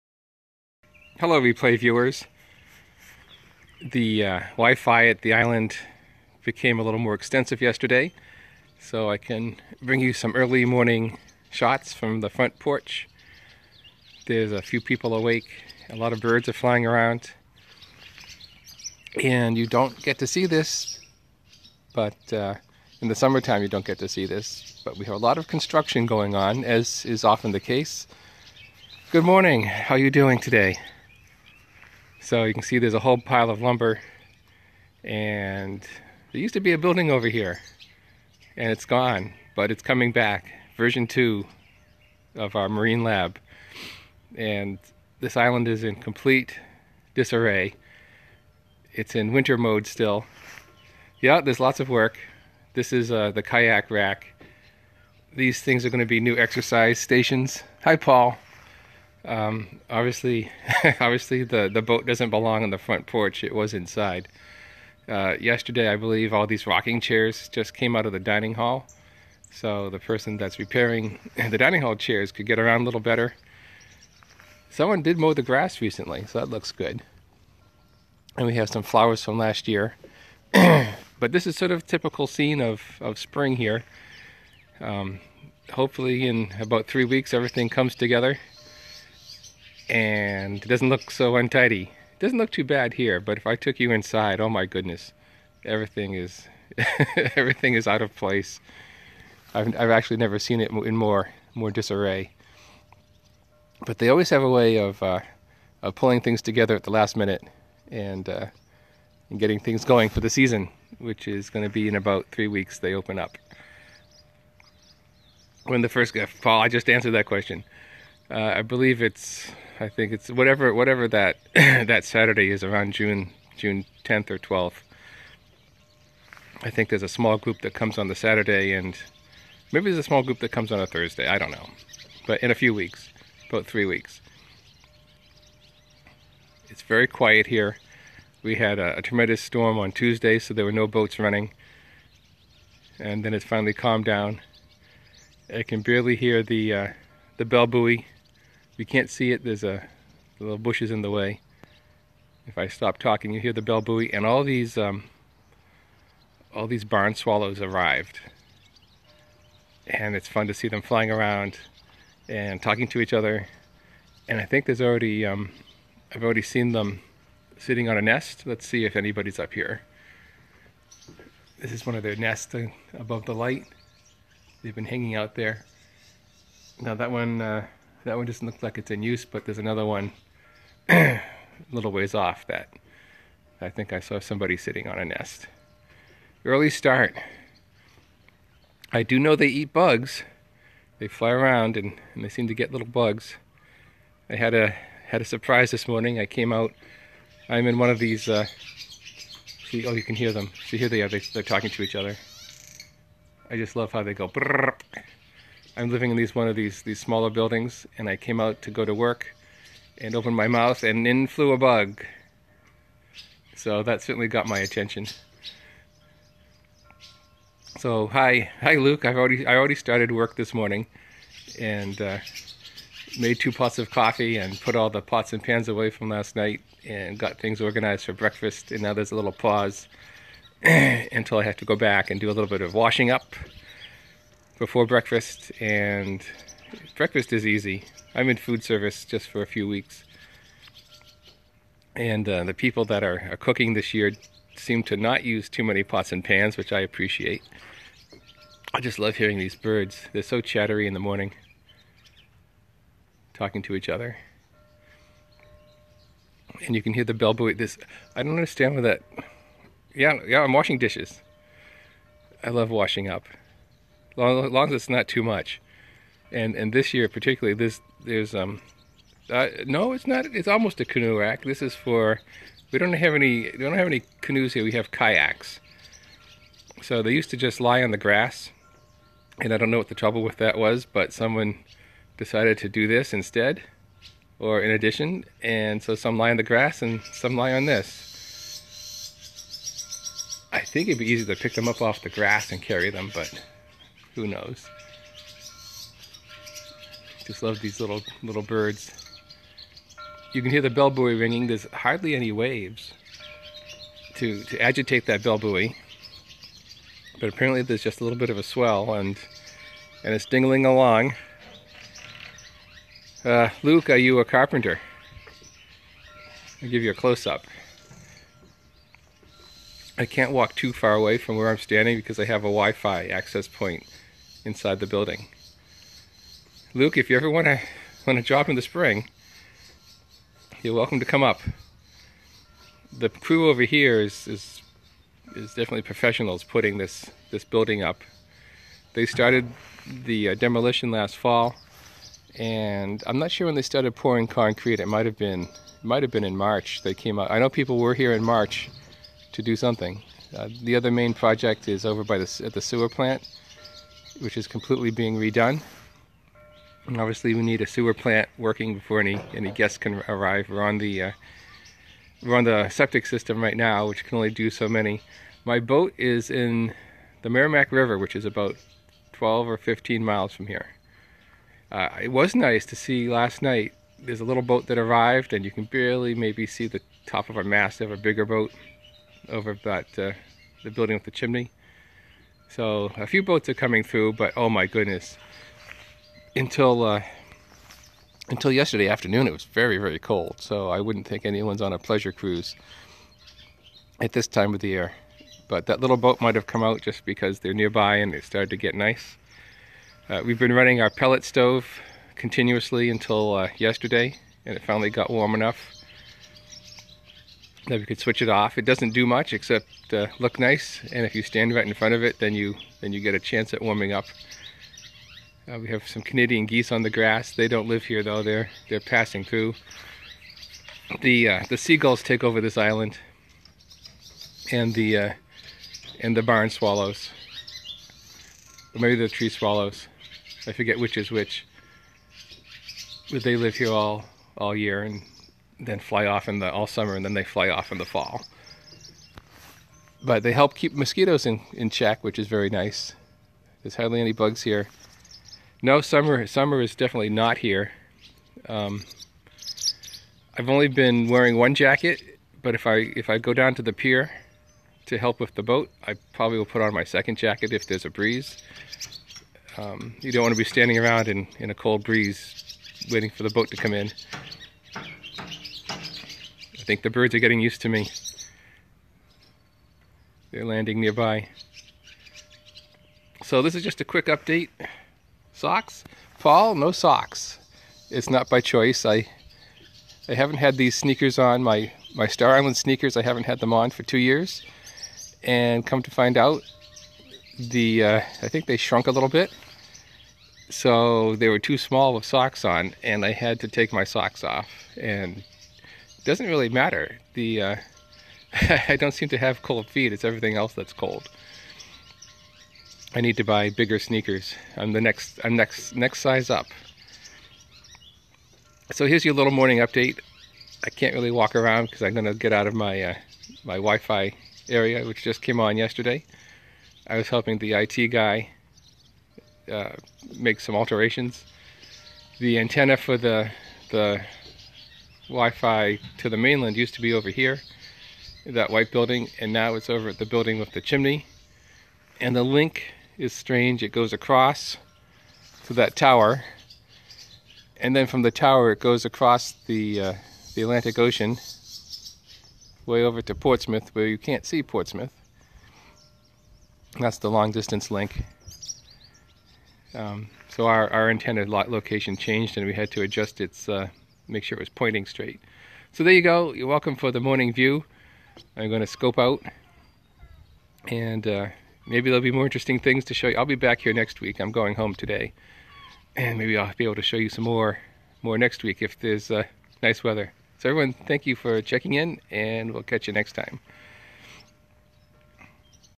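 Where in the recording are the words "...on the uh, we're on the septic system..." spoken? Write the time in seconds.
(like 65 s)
360 s.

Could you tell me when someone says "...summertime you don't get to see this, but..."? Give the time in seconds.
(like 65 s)
23 s.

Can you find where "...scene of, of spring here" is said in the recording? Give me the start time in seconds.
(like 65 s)
82 s.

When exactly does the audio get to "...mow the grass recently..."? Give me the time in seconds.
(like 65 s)
75 s.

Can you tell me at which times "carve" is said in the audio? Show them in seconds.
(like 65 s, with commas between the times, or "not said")
not said.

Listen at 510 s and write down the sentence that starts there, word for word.
I can't really walk around because I'm gonna get out of my uh, my Wi-Fi area, which just came on yesterday.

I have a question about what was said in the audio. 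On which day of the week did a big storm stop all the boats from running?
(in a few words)
Tuesday.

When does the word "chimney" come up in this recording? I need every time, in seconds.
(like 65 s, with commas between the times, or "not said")
381 s, 530 s.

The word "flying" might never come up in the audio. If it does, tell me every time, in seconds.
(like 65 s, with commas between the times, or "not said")
16 s, 160 s.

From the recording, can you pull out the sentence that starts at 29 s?
Good morning, how are you doing today?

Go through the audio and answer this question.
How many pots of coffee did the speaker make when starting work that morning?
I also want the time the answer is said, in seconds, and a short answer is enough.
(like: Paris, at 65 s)
2, at 223 s.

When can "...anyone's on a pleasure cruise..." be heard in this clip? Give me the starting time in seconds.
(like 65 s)
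391 s.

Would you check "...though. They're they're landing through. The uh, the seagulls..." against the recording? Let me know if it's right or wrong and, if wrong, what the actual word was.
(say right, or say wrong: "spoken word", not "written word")
wrong: "passing", not "landing".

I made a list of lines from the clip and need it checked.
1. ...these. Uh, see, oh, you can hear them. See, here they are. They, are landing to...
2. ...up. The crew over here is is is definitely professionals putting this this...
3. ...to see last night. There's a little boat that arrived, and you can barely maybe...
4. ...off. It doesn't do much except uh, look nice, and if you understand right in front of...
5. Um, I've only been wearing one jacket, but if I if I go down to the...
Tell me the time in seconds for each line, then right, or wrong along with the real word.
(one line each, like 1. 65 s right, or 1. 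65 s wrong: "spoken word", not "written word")
1. 197 s wrong: "talking", not "landing"
2. 331 s right
3. 372 s right
4. 408 s wrong: "stand", not "understand"
5. 448 s right.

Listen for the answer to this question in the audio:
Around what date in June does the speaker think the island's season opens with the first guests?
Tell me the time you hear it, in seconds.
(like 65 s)
122 s.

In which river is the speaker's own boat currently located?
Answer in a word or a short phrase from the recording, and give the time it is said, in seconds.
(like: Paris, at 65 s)
Merrimack River, at 367 s.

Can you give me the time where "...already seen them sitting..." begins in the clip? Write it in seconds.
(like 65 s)
166 s.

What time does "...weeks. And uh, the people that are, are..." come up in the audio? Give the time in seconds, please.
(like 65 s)
239 s.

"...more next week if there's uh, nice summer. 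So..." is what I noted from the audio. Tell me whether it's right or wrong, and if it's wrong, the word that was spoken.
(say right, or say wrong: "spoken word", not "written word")
wrong: "weather", not "summer".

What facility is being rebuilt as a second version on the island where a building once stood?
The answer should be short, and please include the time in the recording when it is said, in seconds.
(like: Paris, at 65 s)
marine lab, at 42 s.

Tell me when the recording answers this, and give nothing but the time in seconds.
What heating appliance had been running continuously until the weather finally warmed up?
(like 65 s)
400 s.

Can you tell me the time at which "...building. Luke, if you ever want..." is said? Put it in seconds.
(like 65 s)
324 s.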